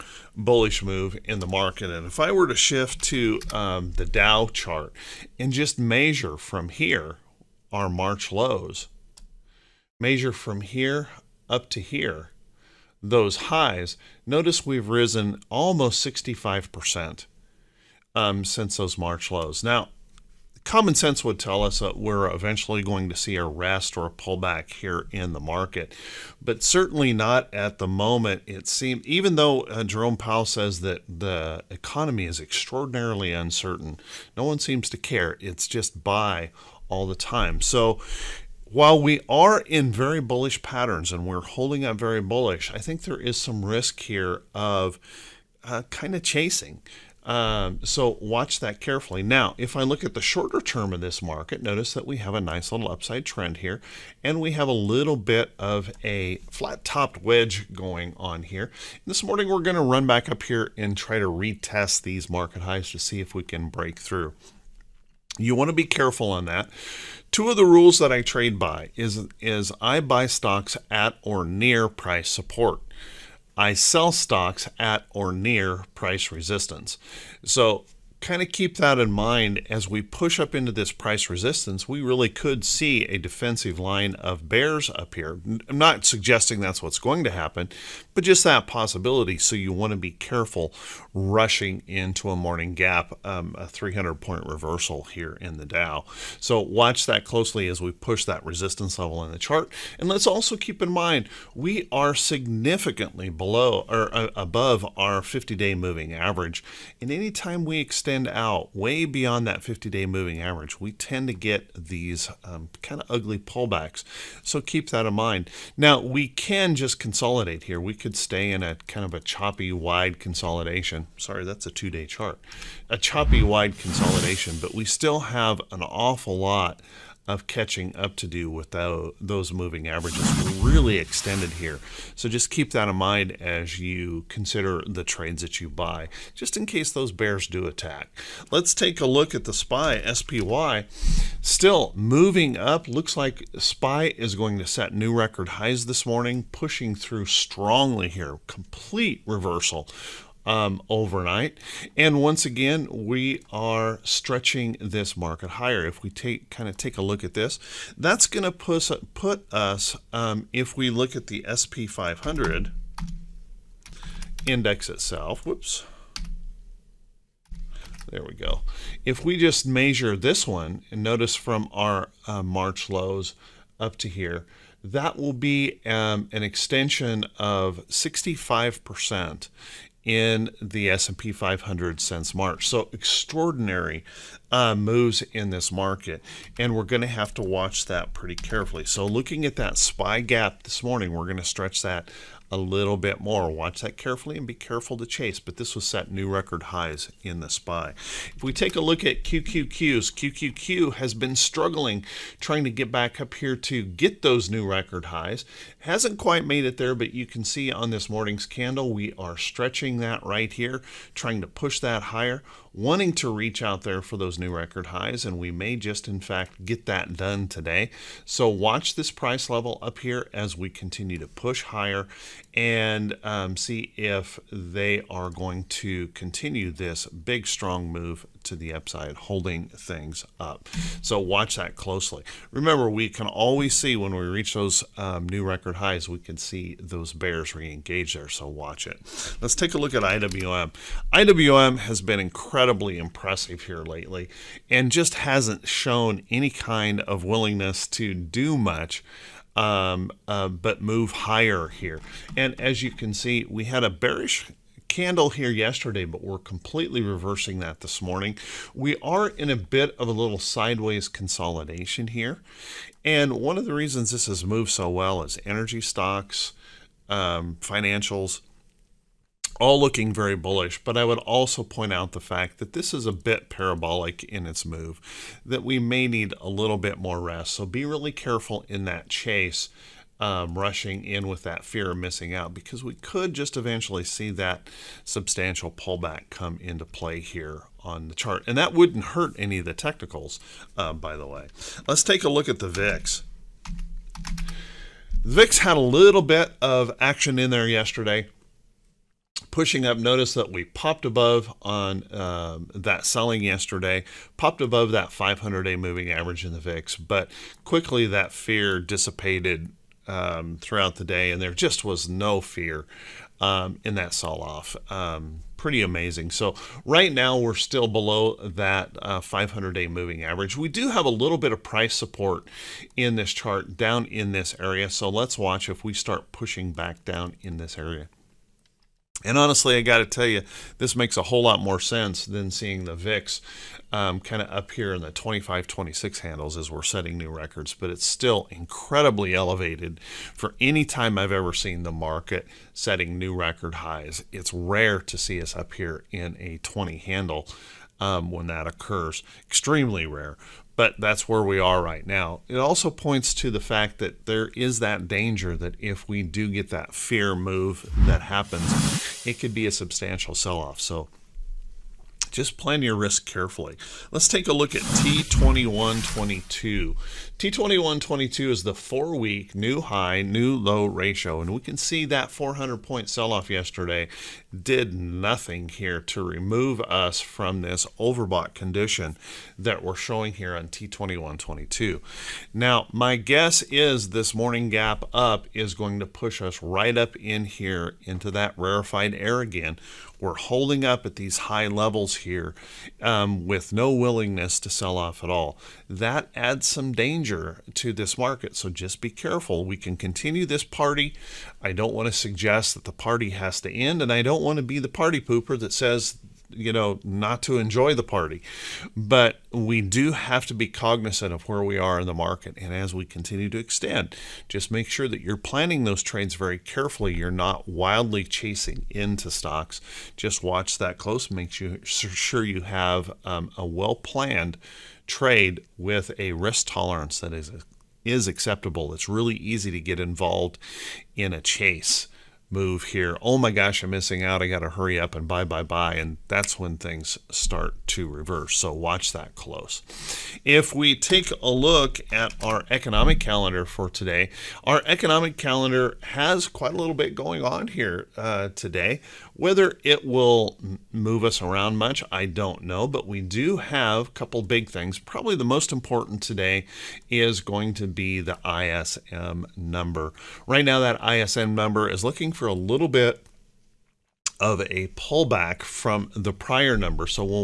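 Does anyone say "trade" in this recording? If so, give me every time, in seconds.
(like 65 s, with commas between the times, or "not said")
68 s, 135 s, 416 s, 425 s.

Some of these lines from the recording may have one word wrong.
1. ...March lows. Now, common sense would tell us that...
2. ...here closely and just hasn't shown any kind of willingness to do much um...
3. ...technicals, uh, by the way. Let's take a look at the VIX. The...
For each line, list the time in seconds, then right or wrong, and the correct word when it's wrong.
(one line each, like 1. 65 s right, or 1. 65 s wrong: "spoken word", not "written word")
1. 18 s right
2. 243 s wrong: "lately", not "closely"
3. 289 s right.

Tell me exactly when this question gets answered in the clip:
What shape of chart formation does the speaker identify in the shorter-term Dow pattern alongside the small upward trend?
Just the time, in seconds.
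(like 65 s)
56 s.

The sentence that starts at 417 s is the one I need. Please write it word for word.
You're not wildly chasing into stocks.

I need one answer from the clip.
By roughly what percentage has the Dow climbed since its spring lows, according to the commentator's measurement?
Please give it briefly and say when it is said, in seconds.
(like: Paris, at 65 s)
65%, at 15 s.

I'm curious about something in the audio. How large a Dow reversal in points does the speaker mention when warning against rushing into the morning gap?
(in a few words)
300 points.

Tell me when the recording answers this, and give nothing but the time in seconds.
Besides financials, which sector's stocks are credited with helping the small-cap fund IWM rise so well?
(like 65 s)
265 s.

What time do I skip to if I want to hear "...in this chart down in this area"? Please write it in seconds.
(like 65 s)
322 s.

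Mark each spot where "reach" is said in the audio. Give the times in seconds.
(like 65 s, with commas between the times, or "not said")
213 s, 234 s.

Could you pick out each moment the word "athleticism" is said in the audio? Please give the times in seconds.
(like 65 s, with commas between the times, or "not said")
not said.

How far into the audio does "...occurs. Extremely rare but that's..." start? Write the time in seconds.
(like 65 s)
348 s.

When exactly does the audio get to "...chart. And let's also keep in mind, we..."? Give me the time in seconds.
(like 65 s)
99 s.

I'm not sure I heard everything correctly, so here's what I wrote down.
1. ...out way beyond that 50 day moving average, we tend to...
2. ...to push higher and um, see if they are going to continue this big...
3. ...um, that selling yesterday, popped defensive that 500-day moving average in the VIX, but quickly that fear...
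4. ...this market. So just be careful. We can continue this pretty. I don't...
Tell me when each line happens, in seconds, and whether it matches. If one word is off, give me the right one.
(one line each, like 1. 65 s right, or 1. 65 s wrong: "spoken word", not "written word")
1. 108 s right
2. 221 s right
3. 302 s wrong: "above", not "defensive"
4. 397 s wrong: "party", not "pretty".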